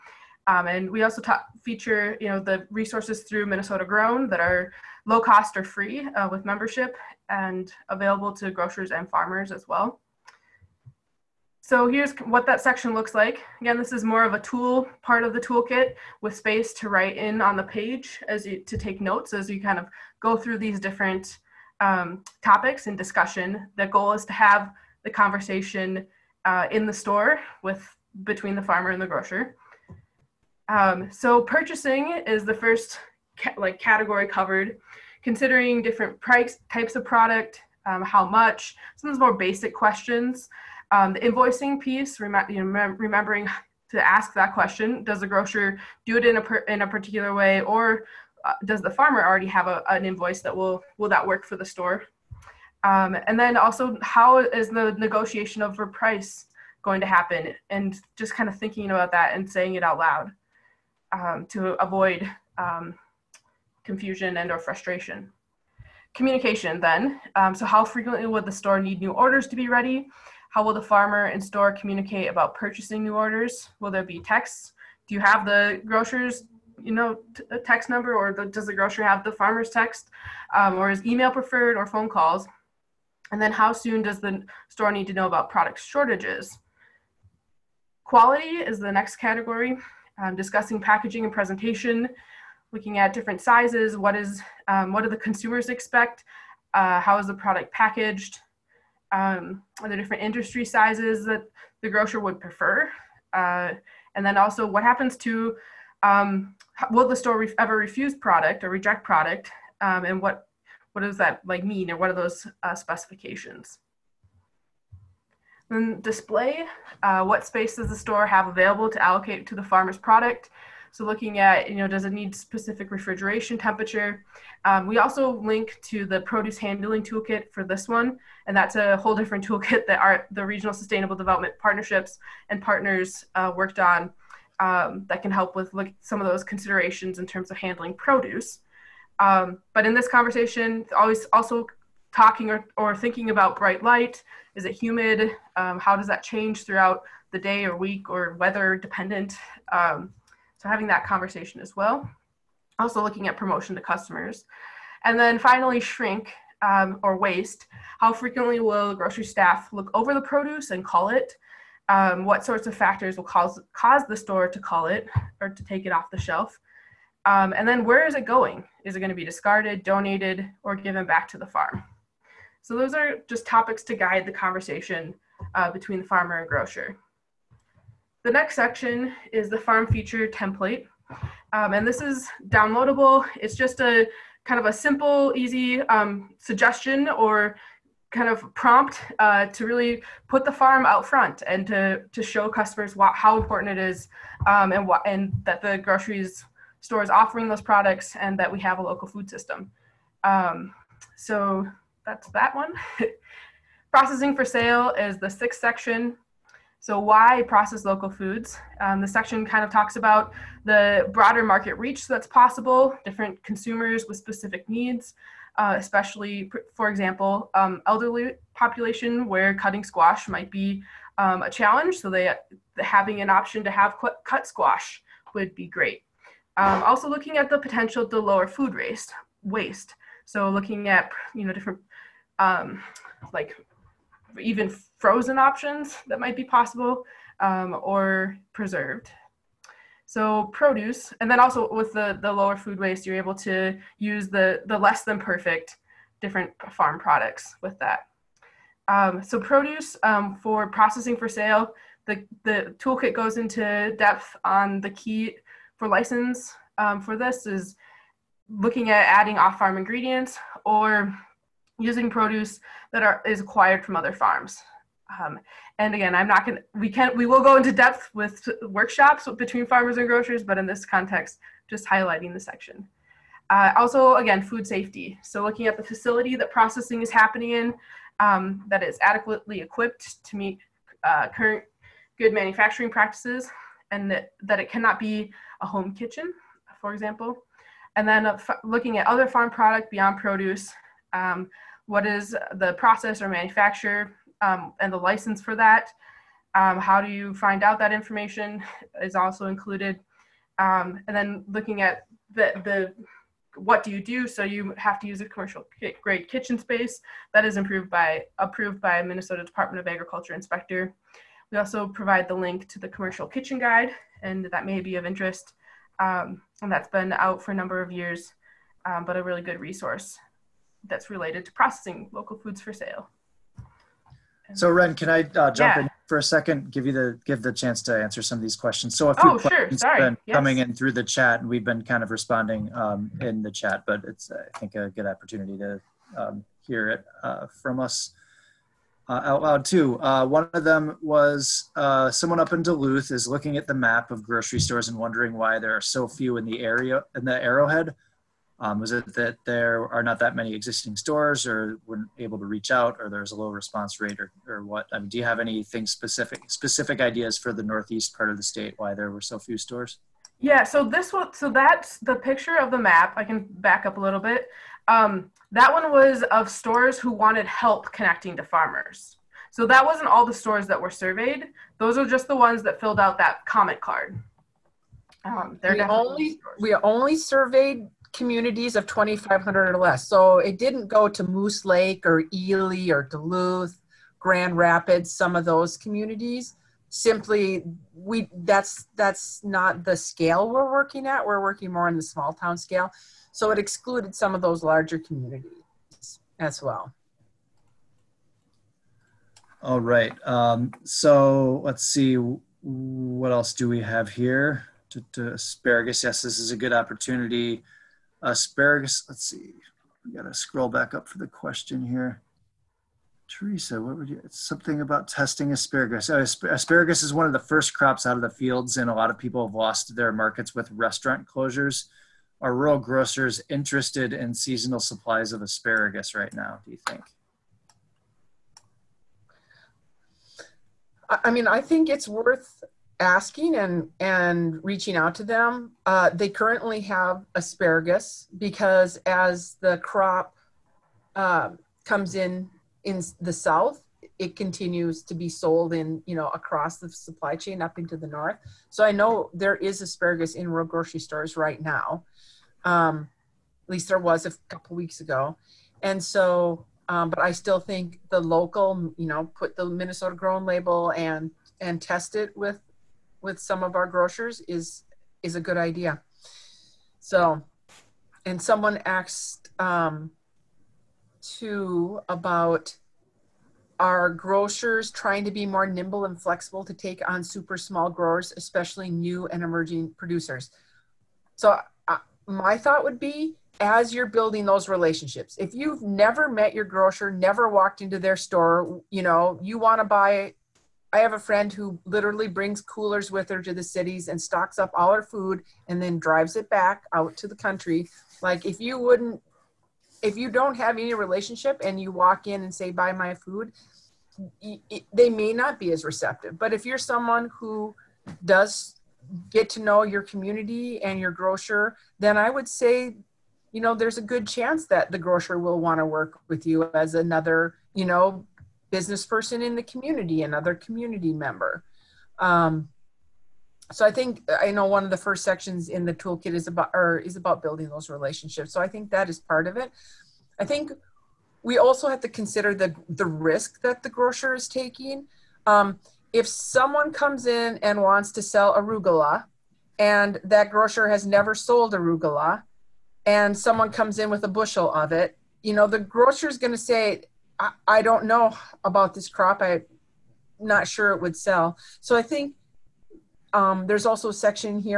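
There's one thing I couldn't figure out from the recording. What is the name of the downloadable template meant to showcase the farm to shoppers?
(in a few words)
farm feature template.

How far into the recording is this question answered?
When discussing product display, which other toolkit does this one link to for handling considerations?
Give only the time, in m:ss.
2:06.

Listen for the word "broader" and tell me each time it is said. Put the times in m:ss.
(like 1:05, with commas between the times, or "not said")
3:31.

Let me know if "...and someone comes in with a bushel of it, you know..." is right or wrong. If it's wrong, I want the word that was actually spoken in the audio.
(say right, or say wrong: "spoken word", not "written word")
right.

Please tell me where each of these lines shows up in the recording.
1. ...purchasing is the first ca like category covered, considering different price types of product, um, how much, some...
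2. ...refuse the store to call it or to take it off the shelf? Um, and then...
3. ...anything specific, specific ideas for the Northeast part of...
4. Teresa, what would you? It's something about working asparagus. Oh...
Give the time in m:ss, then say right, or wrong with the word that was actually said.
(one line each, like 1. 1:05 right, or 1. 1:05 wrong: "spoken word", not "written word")
1. 0:31 right
2. 2:43 wrong: "cause", not "refuse"
3. 5:55 right
4. 6:53 wrong: "testing", not "working".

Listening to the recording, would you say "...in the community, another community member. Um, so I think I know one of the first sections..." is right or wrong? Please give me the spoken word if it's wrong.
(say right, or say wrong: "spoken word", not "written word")
right.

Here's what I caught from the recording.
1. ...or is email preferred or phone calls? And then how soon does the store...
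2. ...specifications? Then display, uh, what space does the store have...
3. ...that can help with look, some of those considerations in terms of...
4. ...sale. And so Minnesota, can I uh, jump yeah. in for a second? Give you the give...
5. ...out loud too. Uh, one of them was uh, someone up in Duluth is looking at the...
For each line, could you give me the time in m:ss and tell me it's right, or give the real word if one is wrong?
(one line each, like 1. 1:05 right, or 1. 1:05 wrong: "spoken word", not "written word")
1. 1:20 right
2. 1:52 right
3. 2:15 right
4. 5:22 wrong: "Ren", not "Minnesota"
5. 5:39 right.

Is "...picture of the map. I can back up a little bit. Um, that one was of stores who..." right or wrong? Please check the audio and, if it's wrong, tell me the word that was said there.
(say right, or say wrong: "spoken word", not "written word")
right.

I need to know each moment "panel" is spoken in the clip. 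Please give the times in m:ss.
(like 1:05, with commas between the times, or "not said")
not said.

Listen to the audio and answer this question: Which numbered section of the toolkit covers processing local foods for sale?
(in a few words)
6th.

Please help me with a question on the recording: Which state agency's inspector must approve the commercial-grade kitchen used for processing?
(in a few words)
Minnesota Department of Agriculture.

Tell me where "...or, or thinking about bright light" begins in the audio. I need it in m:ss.
2:22.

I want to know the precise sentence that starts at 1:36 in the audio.
Uh, how is the product packaged?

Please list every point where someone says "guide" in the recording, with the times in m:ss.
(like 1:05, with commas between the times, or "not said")
2:53, 5:13.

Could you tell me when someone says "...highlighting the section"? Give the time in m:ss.
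4:31.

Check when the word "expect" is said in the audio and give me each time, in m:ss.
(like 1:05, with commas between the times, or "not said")
1:35.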